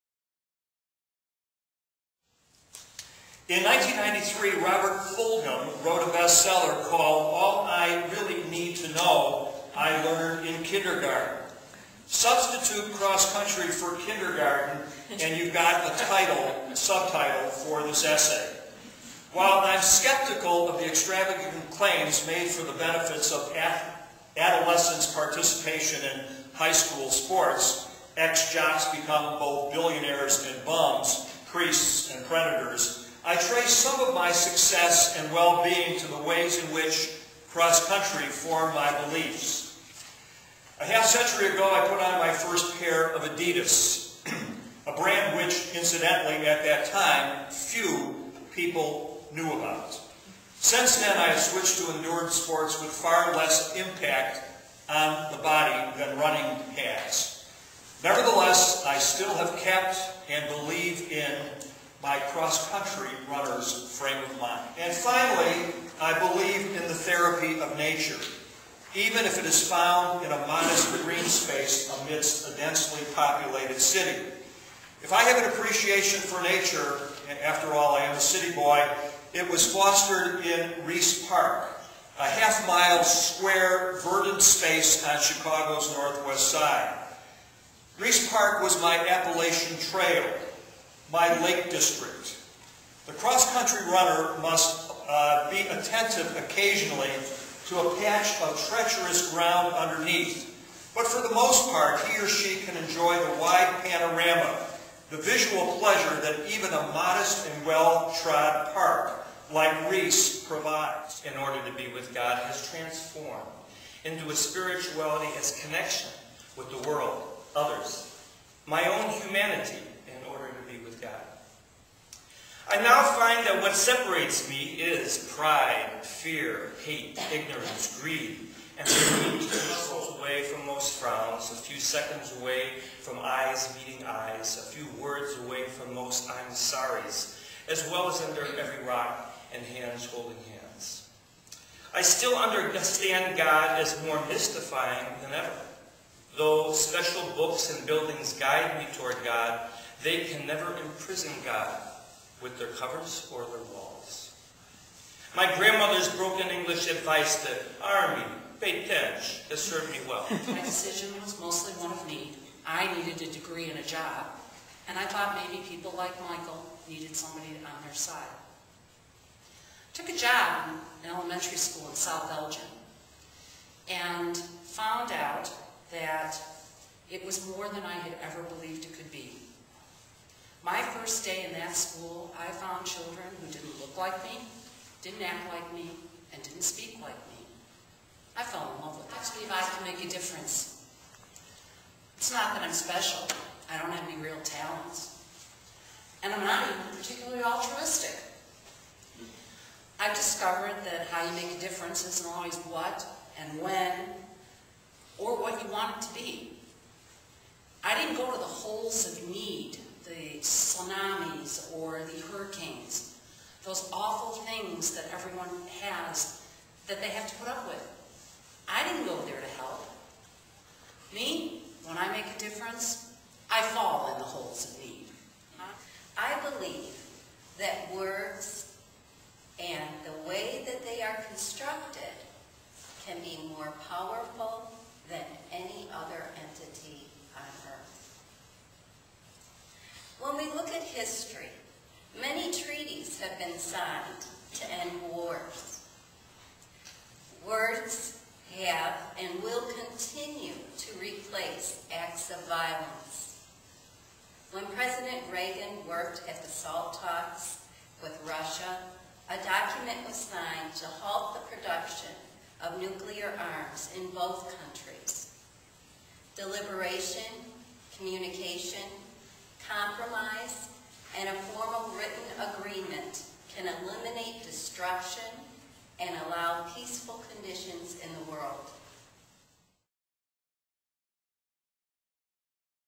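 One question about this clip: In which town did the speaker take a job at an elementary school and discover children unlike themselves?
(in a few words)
South Elgin.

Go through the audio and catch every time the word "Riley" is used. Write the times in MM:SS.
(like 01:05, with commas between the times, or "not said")
not said.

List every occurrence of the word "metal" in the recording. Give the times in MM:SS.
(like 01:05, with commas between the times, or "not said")
not said.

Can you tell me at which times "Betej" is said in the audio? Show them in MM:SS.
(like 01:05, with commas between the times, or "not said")
02:38.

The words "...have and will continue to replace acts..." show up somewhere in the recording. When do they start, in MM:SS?
04:08.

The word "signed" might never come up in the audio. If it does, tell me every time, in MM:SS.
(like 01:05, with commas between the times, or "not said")
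04:03, 04:20.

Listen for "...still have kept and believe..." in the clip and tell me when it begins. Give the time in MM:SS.
00:58.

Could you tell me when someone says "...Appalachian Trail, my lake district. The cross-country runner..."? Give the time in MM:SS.
01:29.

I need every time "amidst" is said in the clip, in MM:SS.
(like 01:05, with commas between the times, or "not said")
01:12.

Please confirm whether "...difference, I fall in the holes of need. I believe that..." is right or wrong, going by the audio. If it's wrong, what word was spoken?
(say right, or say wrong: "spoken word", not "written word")
right.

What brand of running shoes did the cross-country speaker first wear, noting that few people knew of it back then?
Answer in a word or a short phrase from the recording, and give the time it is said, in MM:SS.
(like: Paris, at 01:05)
Adidas, at 00:43.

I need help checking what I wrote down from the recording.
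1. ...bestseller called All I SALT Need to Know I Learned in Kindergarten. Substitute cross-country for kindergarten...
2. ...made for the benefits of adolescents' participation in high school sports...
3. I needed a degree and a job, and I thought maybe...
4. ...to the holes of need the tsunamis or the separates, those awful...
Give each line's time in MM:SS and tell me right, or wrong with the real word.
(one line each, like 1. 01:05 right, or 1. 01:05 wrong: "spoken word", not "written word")
1. 00:06 wrong: "Really", not "SALT"
2. 00:22 right
3. 02:42 right
4. 03:28 wrong: "hurricanes", not "separates".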